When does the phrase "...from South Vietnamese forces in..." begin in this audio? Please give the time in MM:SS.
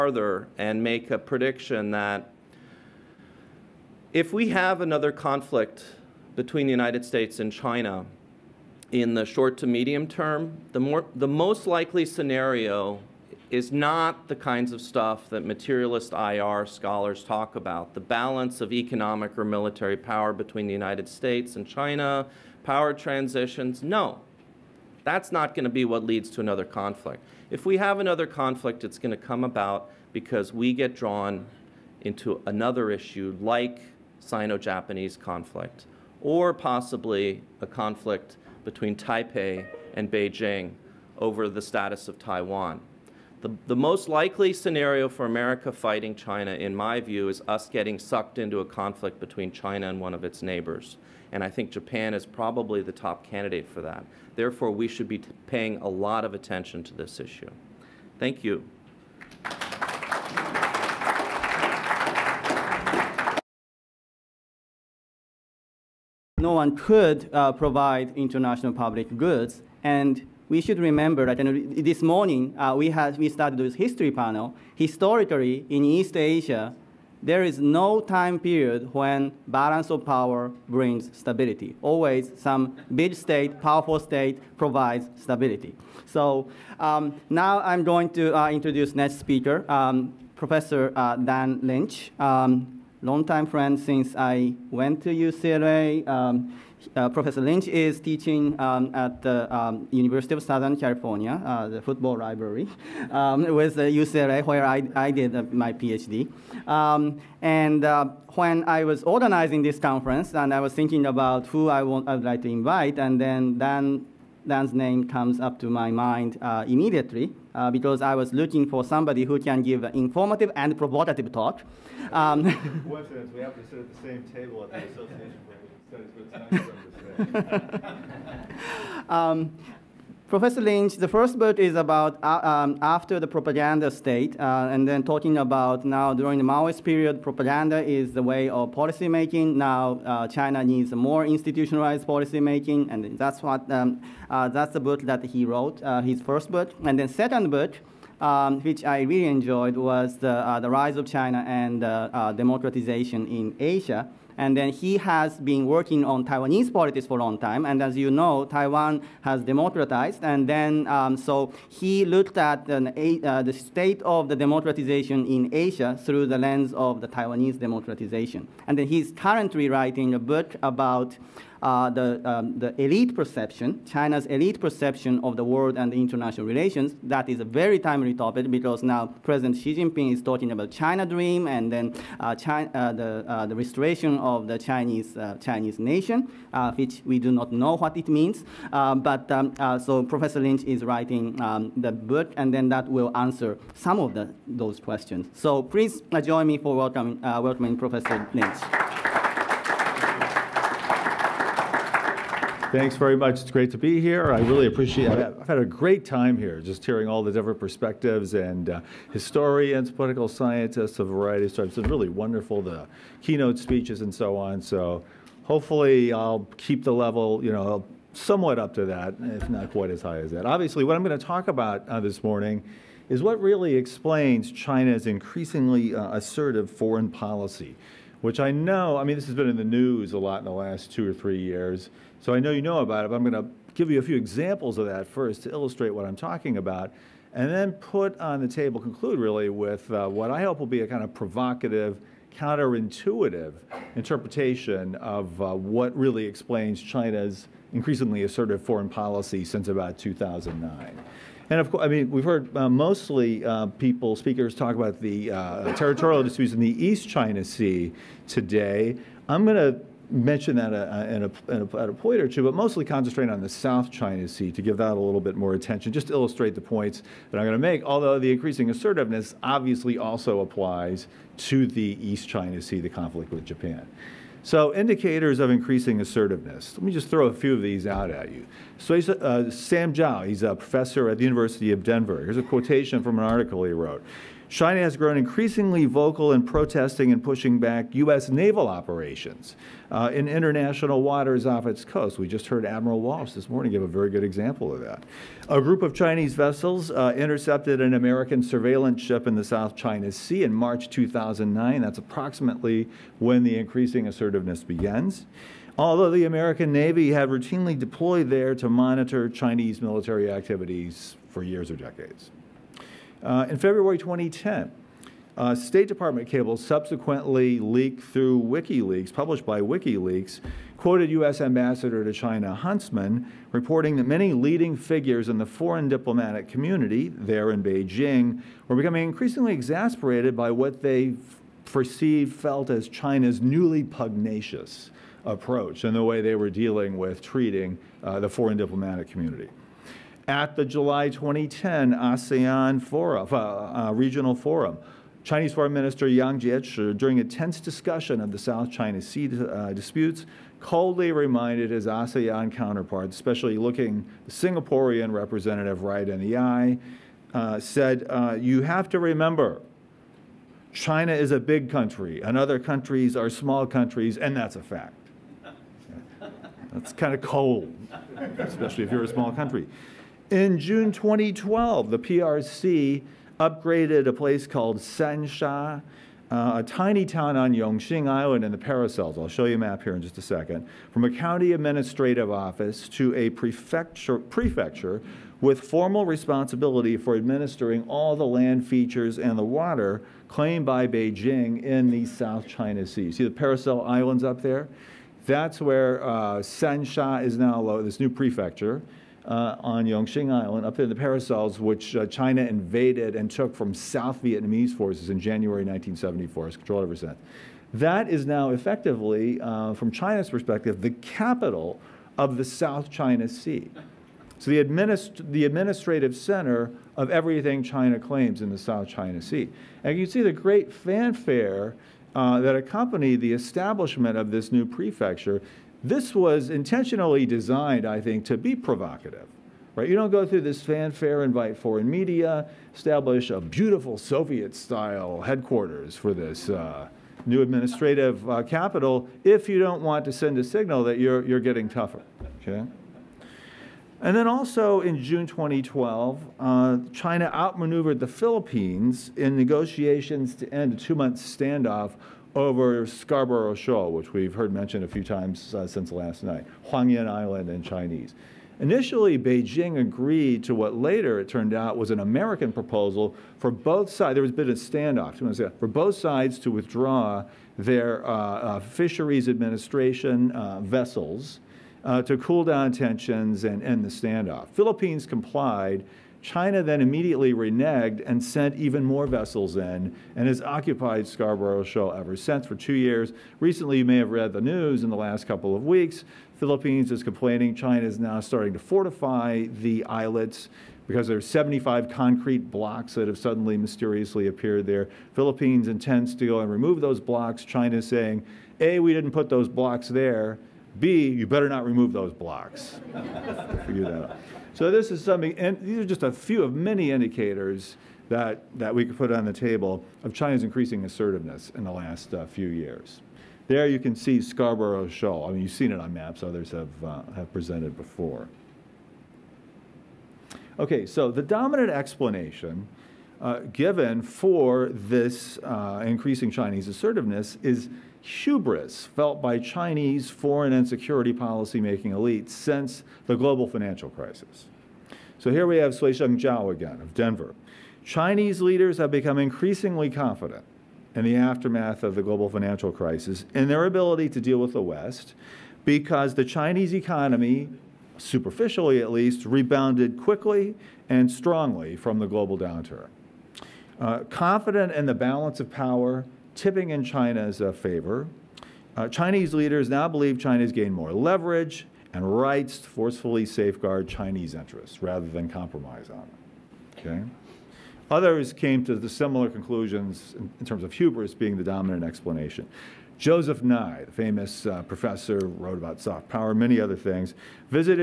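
06:43.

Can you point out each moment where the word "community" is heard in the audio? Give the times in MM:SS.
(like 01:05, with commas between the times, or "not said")
05:26, 05:39.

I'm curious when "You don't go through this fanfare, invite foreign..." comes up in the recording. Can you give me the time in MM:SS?
07:09.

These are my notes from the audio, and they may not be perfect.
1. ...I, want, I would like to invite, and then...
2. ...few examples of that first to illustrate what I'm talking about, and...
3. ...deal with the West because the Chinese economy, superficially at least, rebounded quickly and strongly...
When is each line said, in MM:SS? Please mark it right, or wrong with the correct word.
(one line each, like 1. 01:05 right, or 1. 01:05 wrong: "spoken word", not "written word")
1. 01:51 right
2. 03:54 right
3. 09:04 right.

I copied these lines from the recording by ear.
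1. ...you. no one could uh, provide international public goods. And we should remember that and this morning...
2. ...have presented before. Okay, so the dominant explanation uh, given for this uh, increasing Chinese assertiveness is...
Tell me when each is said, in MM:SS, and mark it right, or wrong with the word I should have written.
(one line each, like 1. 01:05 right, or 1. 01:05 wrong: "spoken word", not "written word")
1. 00:58 right
2. 08:37 right.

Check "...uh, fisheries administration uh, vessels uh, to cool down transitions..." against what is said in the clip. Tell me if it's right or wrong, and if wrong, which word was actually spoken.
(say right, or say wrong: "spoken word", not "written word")
wrong: "tensions", not "transitions".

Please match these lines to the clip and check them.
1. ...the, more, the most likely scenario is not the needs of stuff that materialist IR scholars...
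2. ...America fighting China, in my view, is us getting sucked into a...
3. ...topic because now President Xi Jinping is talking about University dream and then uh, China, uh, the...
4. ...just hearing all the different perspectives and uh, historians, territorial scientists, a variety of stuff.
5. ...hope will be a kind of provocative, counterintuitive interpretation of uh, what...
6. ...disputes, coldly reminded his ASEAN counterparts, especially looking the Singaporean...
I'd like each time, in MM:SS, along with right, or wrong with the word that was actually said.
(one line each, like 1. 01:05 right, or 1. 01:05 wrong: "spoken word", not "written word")
1. 00:10 wrong: "kinds", not "needs"
2. 00:45 right
3. 02:58 wrong: "China", not "University"
4. 03:26 wrong: "political", not "territorial"
5. 04:00 right
6. 05:49 right.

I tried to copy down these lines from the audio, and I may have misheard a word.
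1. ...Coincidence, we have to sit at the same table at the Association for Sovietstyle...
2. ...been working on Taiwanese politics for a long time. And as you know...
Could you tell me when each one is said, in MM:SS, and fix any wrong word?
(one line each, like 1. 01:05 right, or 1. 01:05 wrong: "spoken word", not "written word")
1. 02:02 wrong: "Studies", not "Sovietstyle"
2. 02:35 right.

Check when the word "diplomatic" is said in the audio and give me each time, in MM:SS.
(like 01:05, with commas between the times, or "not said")
05:25, 05:38.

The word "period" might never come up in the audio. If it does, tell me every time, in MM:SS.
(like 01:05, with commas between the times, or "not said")
01:18, 02:16.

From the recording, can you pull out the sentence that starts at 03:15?
So please join me for welcoming, welcoming Professor Lynch.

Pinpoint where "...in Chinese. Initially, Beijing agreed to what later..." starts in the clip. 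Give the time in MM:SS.
07:37.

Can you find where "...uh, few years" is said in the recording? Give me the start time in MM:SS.
08:32.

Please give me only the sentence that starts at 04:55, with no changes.
A group of Chinese vessels uh, intercepted an American surveillance ship in the South China Sea in March 2009.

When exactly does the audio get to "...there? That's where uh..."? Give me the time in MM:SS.
06:34.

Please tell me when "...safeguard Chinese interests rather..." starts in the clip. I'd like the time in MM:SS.
09:23.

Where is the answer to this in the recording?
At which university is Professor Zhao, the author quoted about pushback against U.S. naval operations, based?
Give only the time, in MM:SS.
04:41.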